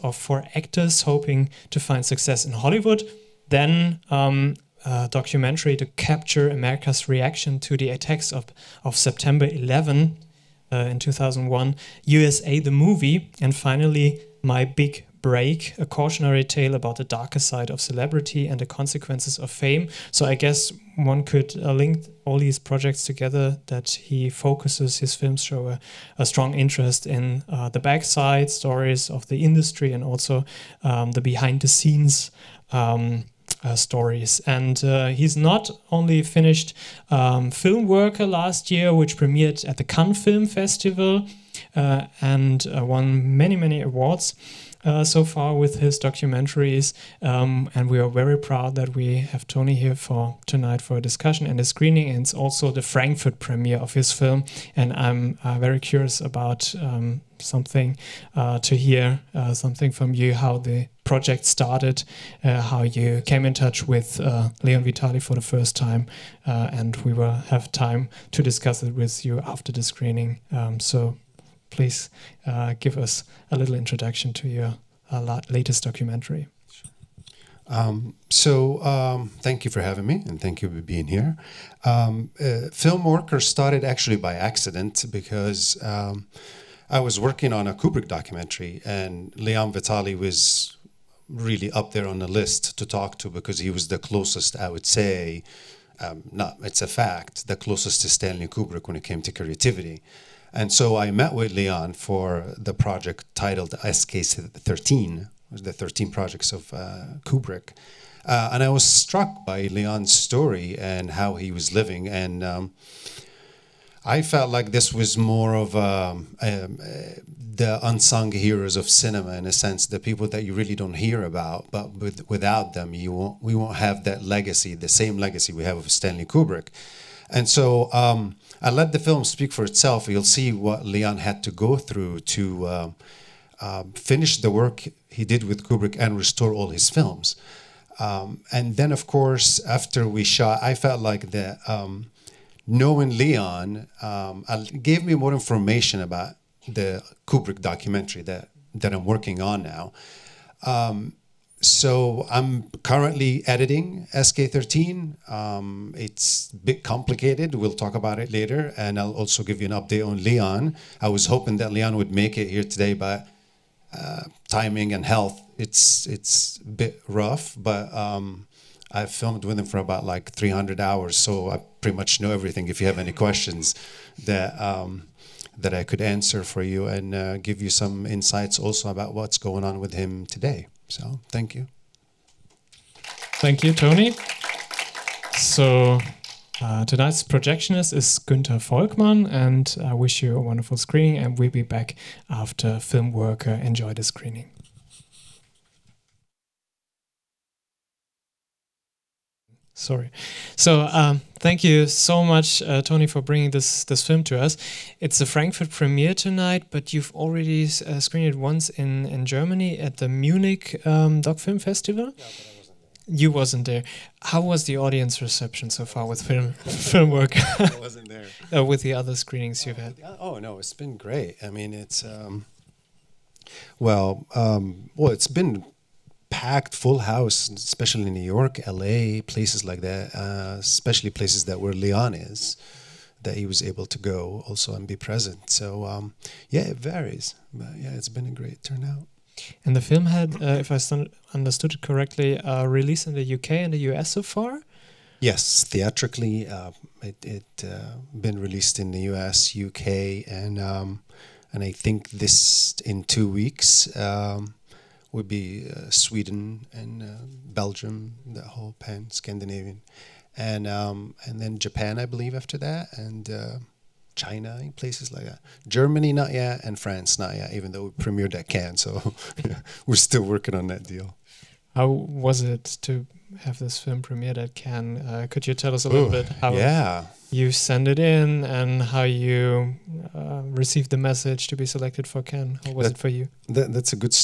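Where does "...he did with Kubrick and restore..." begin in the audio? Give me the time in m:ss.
2:15.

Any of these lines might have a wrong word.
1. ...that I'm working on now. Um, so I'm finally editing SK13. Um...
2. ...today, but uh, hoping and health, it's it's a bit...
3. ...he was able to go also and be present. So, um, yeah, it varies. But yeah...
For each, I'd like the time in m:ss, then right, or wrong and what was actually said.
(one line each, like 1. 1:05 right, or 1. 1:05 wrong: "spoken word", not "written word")
1. 2:28 wrong: "currently", not "finally"
2. 2:42 wrong: "timing", not "hoping"
3. 3:53 right.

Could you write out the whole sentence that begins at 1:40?
And so I met with Leon for the project titled SK13, the 13 projects of uh, Kubrick.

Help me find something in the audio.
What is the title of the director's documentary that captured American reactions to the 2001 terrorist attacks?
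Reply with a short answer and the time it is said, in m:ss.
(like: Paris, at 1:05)
USA the Movie, at 0:12.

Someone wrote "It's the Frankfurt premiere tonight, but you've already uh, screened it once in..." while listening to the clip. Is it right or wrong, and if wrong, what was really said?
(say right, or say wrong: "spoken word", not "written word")
right.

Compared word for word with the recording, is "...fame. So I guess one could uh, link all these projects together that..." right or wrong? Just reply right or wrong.
right.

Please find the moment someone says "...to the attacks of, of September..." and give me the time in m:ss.
0:07.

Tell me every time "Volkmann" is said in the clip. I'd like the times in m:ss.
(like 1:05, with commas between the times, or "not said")
3:08.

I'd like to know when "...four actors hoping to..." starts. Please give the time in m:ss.
0:00.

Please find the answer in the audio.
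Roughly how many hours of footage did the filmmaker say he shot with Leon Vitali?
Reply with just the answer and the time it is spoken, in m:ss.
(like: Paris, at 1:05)
300, at 2:50.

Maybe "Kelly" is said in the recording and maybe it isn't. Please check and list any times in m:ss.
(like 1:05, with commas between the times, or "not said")
not said.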